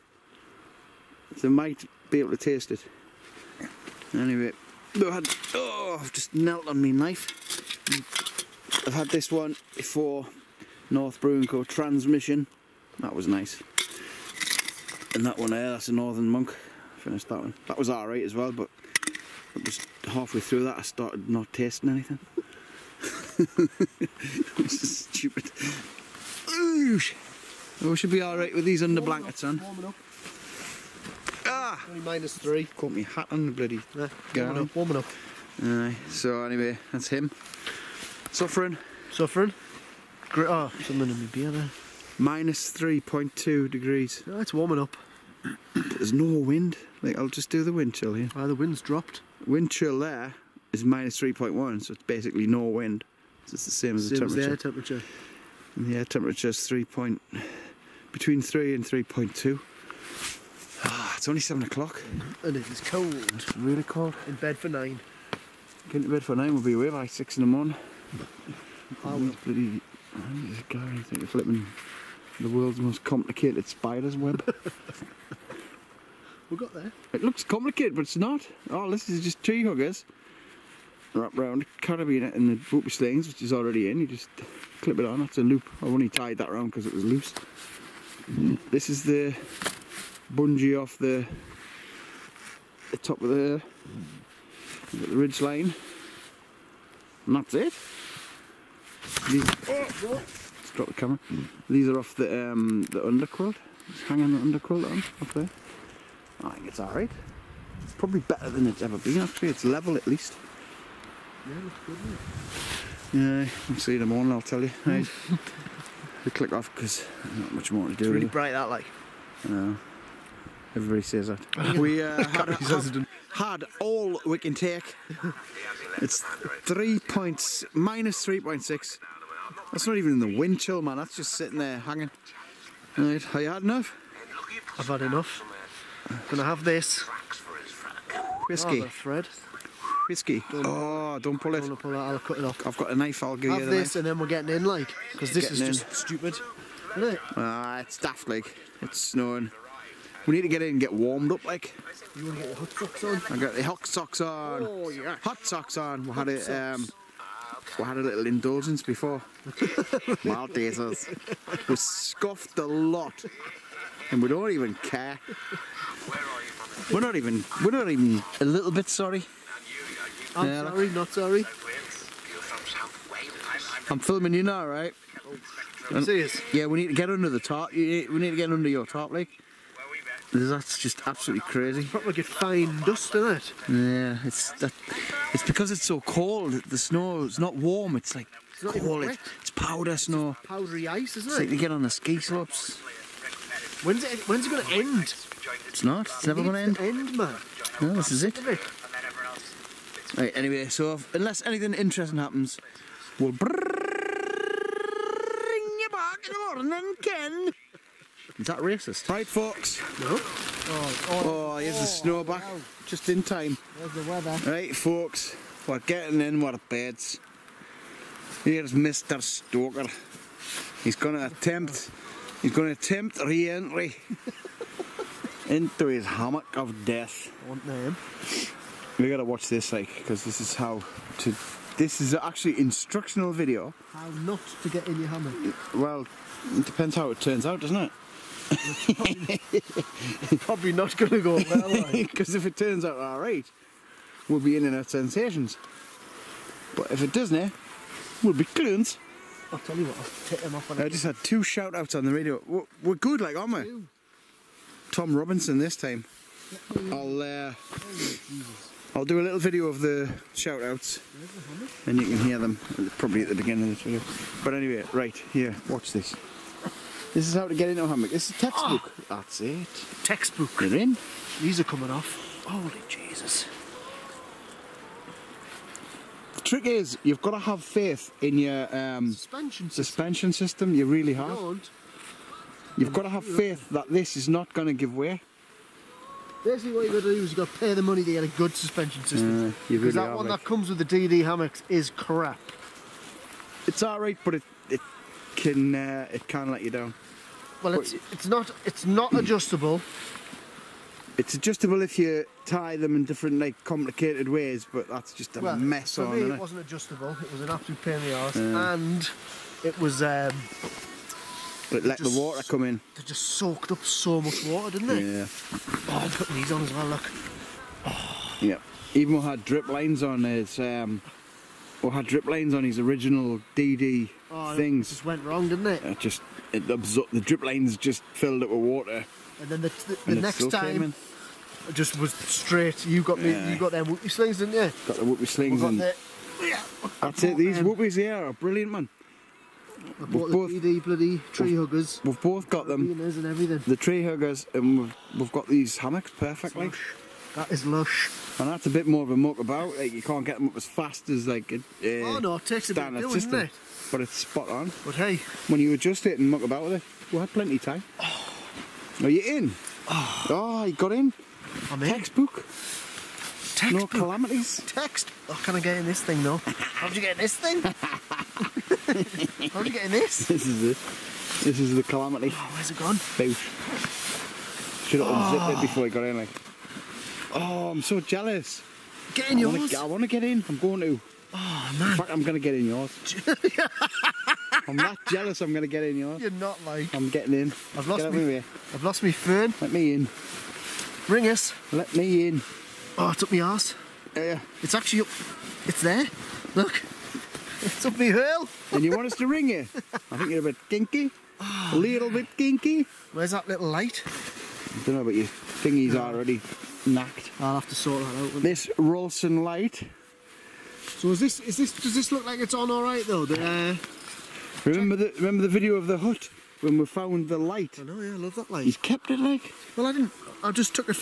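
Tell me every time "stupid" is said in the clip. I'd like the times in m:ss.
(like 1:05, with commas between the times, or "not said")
0:25, 2:25.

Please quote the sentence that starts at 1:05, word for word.
Getting to bed for 9 will be away by 6 in the morning.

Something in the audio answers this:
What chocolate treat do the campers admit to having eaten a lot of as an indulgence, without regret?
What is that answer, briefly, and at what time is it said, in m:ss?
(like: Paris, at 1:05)
Maltesers, at 2:40.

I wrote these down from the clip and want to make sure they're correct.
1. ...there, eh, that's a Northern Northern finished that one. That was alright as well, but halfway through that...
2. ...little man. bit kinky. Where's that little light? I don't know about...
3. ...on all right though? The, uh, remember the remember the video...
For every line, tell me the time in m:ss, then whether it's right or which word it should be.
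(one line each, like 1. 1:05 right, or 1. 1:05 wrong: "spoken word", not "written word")
1. 0:15 wrong: "Monk", not "Northern"
2. 6:41 right
3. 6:52 right.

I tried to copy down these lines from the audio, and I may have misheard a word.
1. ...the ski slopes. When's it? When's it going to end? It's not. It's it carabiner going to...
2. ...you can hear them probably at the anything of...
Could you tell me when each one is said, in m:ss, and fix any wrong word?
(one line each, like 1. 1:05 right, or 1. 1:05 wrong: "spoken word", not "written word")
1. 3:11 wrong: "never", not "carabiner"
2. 4:21 wrong: "beginning", not "anything".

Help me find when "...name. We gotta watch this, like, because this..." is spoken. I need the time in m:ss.
3:47.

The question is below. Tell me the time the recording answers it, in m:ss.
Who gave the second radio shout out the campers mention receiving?
4:14.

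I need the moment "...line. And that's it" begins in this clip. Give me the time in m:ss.
1:35.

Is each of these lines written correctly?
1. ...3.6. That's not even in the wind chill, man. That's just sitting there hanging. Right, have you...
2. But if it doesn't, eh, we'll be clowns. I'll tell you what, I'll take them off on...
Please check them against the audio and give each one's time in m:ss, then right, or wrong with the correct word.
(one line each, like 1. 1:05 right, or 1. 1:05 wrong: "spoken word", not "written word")
1. 2:08 right
2. 4:06 right.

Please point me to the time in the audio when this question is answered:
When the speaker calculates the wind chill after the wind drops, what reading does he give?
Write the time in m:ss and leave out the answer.
0:50.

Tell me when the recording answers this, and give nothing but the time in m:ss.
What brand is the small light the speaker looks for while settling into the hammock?
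6:48.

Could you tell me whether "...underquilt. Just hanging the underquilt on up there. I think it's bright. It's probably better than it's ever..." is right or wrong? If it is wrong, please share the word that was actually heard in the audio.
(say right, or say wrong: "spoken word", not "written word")
wrong: "alright", not "bright".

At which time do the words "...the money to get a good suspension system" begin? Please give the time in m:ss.
4:47.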